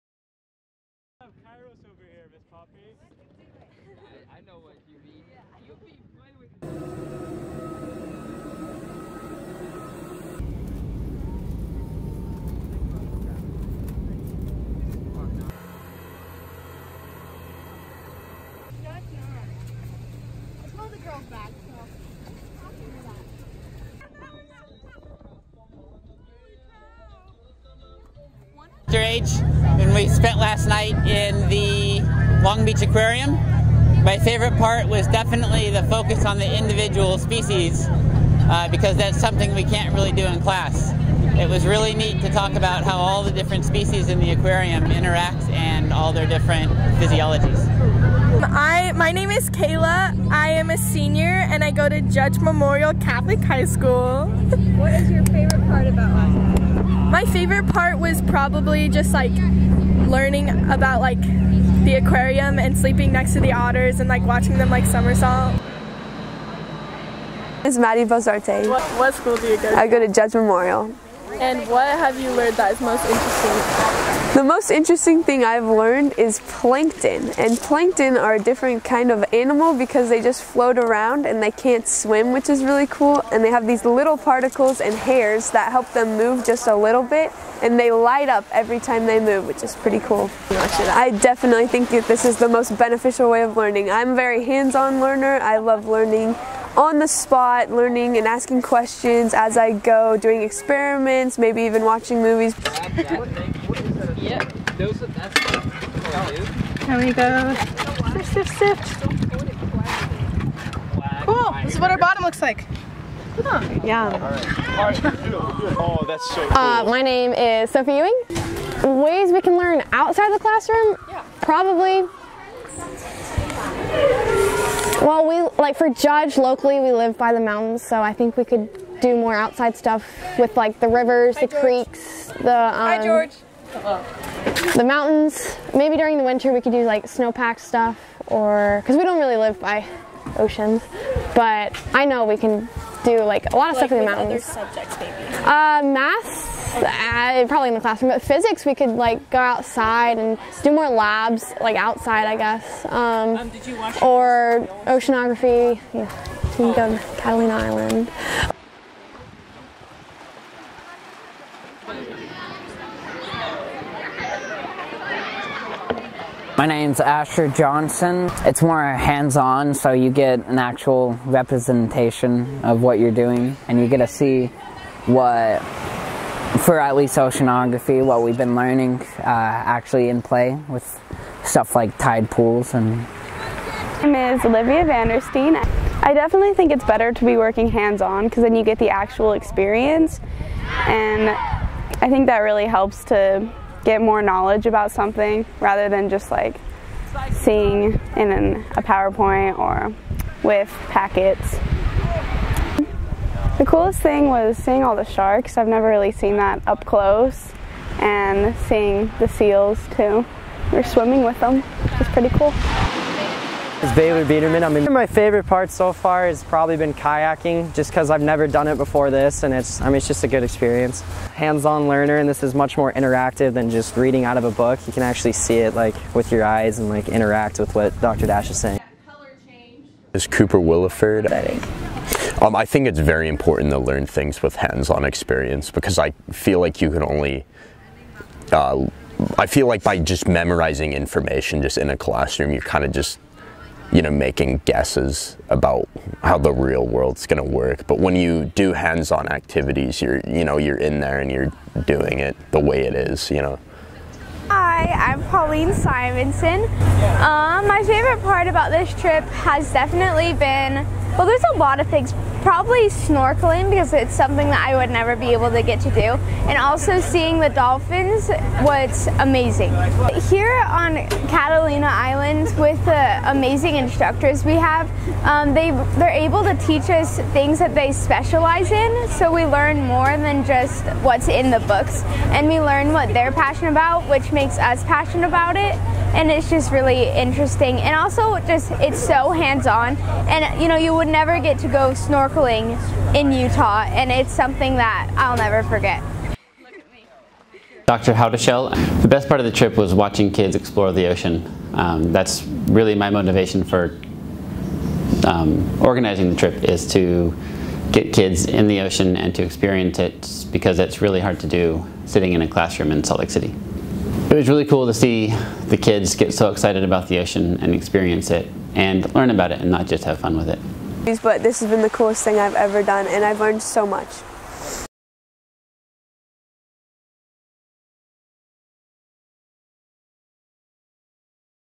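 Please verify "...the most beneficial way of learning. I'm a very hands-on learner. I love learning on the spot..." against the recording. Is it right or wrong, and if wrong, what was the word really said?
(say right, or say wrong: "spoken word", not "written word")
right.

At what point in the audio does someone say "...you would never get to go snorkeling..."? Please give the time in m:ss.
4:50.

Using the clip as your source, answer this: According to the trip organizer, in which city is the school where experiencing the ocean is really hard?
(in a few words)
Salt Lake City.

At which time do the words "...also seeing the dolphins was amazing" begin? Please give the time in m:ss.
4:26.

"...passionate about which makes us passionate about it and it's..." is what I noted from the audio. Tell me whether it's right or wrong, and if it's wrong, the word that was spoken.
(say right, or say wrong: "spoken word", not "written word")
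right.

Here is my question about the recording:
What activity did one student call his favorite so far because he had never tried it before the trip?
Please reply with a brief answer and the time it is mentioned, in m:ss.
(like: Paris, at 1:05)
Kayaking, at 3:36.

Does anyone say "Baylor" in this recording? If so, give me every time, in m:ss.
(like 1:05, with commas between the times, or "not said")
3:33.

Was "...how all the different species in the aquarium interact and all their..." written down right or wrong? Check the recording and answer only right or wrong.
right.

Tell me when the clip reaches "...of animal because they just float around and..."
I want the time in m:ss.
1:19.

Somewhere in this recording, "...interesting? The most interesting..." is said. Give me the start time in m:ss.
1:13.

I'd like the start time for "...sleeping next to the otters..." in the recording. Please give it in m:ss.
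1:02.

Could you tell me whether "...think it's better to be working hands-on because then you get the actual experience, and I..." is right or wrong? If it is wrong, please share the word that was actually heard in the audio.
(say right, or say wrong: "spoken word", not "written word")
right.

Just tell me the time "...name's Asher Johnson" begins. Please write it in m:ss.
2:46.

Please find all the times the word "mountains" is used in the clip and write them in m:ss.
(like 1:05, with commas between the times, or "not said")
2:07, 2:14, 2:24.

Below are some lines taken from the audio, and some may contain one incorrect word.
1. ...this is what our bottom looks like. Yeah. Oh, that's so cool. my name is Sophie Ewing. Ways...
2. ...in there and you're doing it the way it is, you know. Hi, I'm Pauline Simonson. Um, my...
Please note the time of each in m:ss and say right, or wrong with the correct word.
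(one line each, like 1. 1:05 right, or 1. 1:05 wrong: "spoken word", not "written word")
1. 1:51 right
2. 4:10 right.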